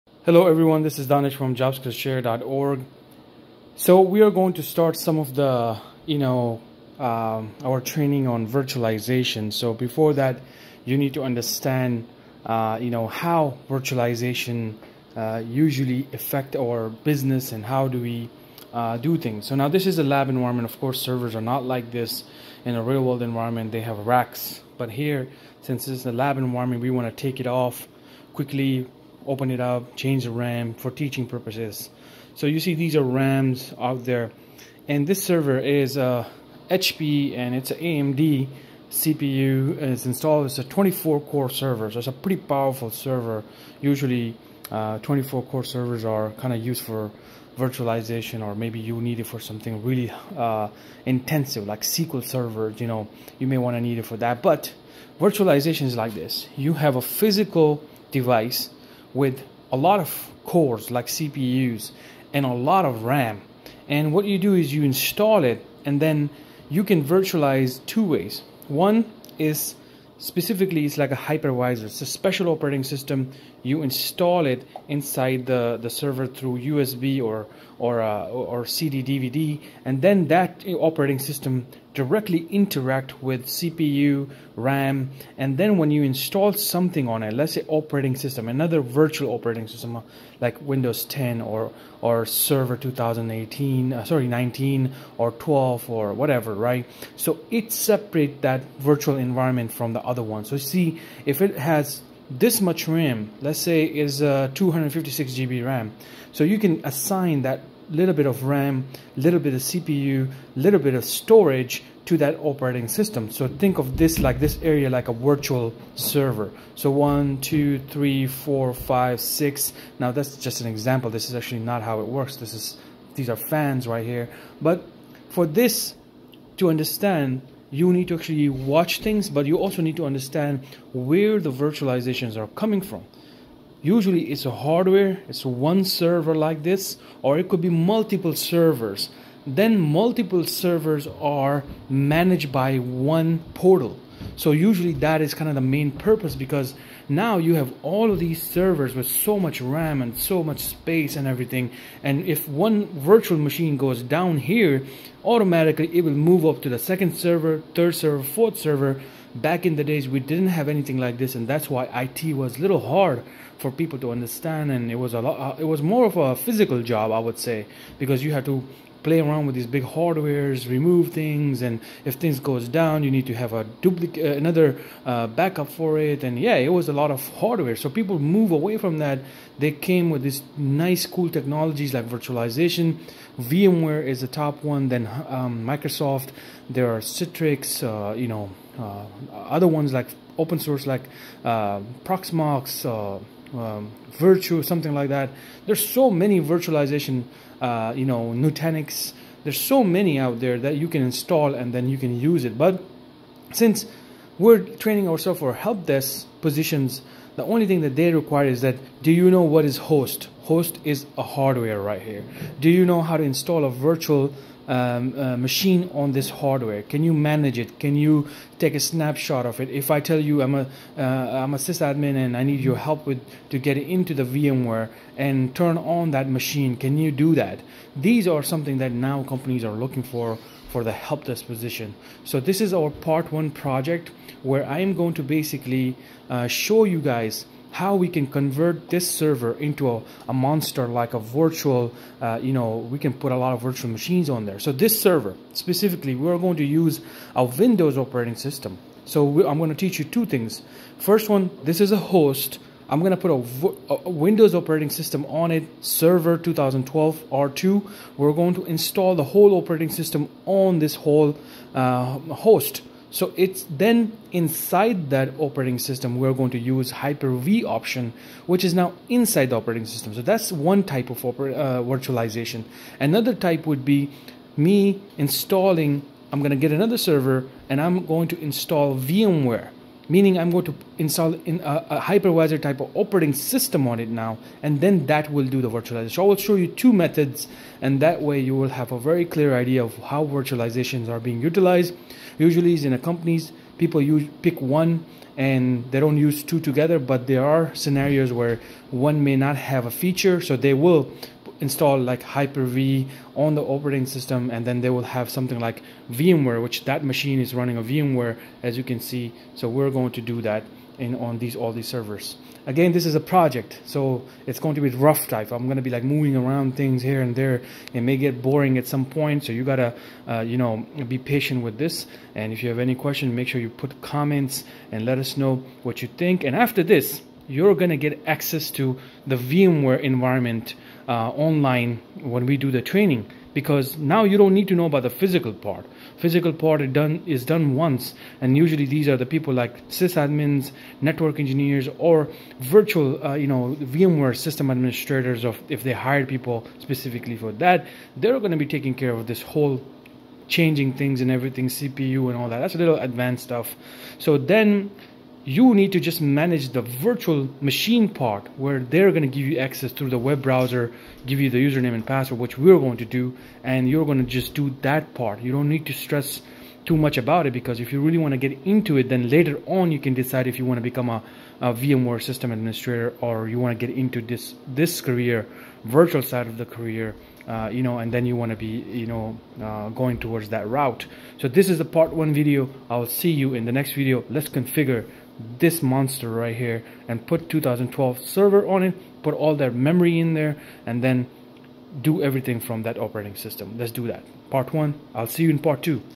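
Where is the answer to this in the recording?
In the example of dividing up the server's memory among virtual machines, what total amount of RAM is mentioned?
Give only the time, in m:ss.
1:44.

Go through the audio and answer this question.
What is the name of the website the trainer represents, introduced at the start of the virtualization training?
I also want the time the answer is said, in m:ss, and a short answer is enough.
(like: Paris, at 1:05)
jobskillshare.org, at 0:01.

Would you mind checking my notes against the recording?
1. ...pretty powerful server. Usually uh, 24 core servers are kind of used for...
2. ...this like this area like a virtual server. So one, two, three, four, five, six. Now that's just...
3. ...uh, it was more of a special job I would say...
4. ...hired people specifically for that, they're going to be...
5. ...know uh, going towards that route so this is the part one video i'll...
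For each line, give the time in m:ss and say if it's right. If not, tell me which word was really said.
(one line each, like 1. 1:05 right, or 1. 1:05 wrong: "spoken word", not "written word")
1. 0:42 right
2. 1:53 right
3. 2:45 wrong: "physical", not "special"
4. 5:45 right
5. 6:19 right.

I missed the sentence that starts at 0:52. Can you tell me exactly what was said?
You know, you may want to need it for that.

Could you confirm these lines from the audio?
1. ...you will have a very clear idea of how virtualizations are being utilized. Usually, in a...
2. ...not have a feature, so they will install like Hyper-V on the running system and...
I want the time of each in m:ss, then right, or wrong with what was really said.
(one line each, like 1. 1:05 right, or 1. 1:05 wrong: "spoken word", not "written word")
1. 4:48 right
2. 4:59 wrong: "operating", not "running".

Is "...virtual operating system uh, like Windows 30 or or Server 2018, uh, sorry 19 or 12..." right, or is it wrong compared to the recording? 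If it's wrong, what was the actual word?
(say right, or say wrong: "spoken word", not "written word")
wrong: "10", not "30".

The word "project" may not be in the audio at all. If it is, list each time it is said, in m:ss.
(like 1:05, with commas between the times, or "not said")
3:53, 5:13.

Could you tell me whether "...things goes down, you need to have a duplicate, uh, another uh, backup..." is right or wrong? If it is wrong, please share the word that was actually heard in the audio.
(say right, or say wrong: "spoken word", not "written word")
right.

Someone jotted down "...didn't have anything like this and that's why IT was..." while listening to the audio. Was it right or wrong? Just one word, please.
right.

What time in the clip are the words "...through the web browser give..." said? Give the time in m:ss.
5:59.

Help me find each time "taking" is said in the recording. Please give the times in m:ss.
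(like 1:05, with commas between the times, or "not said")
5:48.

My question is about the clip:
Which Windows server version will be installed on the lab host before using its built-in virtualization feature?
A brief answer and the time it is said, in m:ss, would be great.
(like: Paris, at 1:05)
Server 2012 R2, at 4:15.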